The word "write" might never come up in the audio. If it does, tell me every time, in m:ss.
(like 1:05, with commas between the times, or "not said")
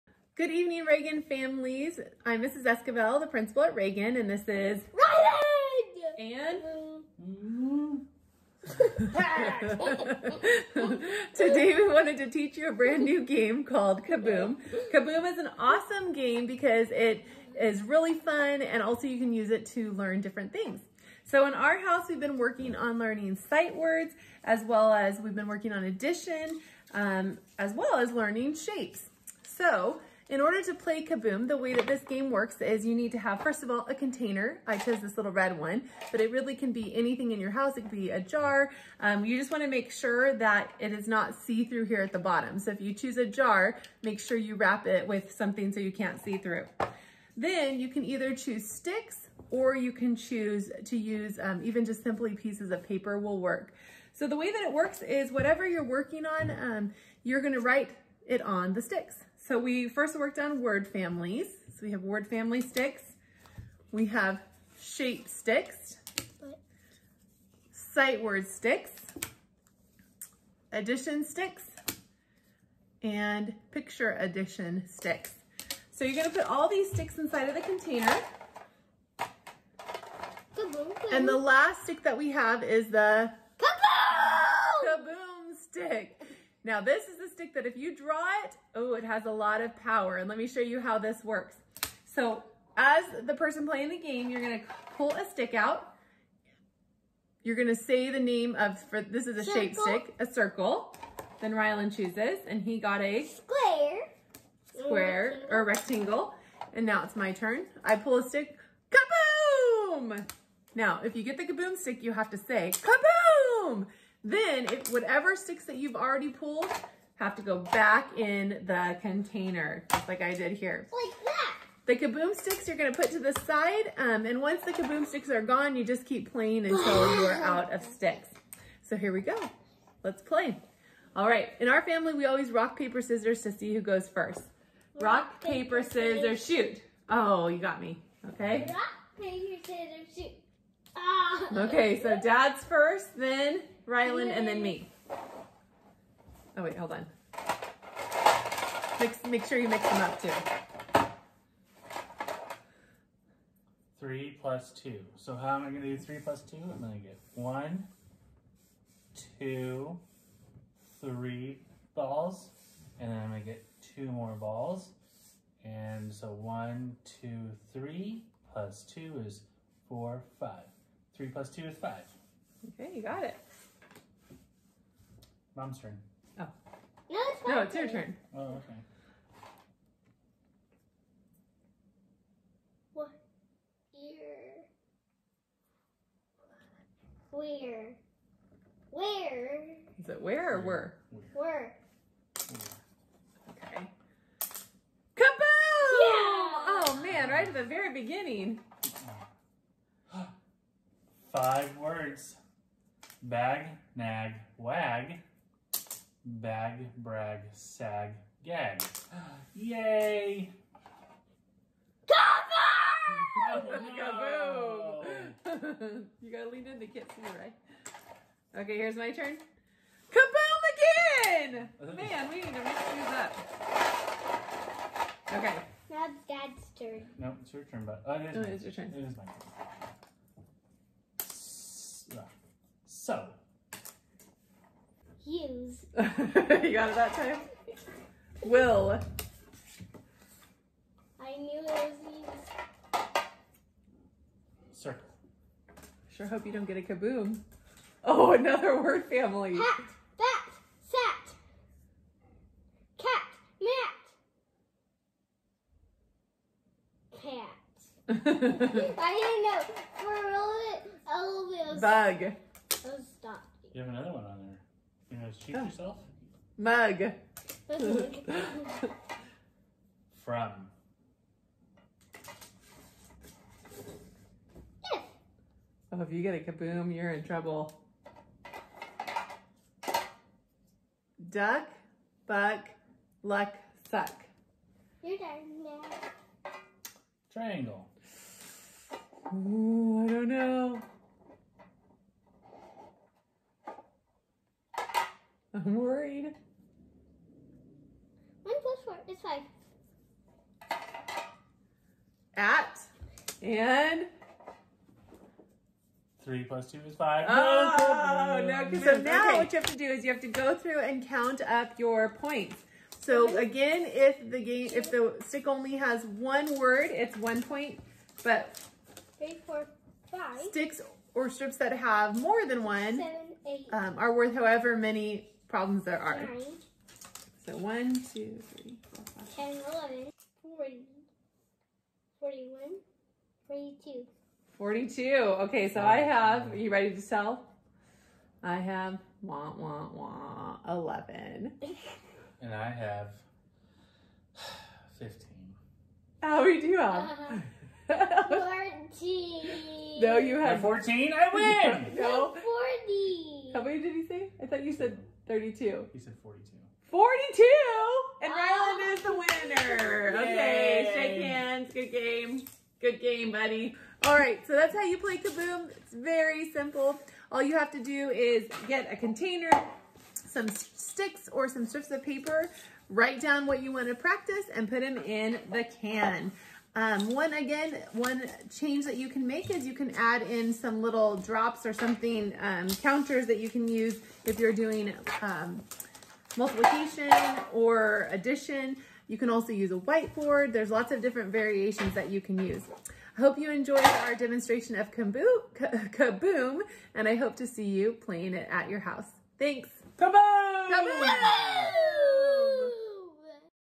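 0:57, 6:12.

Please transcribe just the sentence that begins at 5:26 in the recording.
Nine, so one, two, three, four, five.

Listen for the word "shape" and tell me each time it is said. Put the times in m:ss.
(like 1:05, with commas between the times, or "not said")
0:28, 1:04, 1:39.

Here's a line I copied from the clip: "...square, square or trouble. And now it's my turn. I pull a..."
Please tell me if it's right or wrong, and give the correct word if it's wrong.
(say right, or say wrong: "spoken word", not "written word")
wrong: "rectangle", not "trouble".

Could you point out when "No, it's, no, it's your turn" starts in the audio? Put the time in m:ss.
2:57.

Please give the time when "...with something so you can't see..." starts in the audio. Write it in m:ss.
0:45.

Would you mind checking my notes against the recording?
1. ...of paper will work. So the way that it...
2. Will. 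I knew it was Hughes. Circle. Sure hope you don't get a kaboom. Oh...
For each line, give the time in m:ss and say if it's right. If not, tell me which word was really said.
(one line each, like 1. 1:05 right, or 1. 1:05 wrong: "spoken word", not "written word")
1. 0:52 right
2. 3:58 right.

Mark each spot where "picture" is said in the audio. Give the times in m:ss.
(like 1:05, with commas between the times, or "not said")
1:13.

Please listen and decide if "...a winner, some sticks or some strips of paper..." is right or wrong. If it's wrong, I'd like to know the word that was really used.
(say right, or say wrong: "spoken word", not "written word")
wrong: "container", not "winner".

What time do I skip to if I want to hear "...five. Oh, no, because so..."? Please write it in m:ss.
5:06.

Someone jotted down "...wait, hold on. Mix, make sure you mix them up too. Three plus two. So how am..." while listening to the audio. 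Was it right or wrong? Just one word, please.
right.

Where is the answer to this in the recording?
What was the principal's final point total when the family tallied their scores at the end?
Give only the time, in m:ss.
5:40.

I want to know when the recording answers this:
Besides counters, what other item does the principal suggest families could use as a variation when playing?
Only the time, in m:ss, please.
6:29.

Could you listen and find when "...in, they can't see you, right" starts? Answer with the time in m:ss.
3:36.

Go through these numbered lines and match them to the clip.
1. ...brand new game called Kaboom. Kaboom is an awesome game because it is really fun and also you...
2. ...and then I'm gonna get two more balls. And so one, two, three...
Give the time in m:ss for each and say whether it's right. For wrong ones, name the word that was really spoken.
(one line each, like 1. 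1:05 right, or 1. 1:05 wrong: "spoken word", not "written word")
1. 0:12 right
2. 2:42 right.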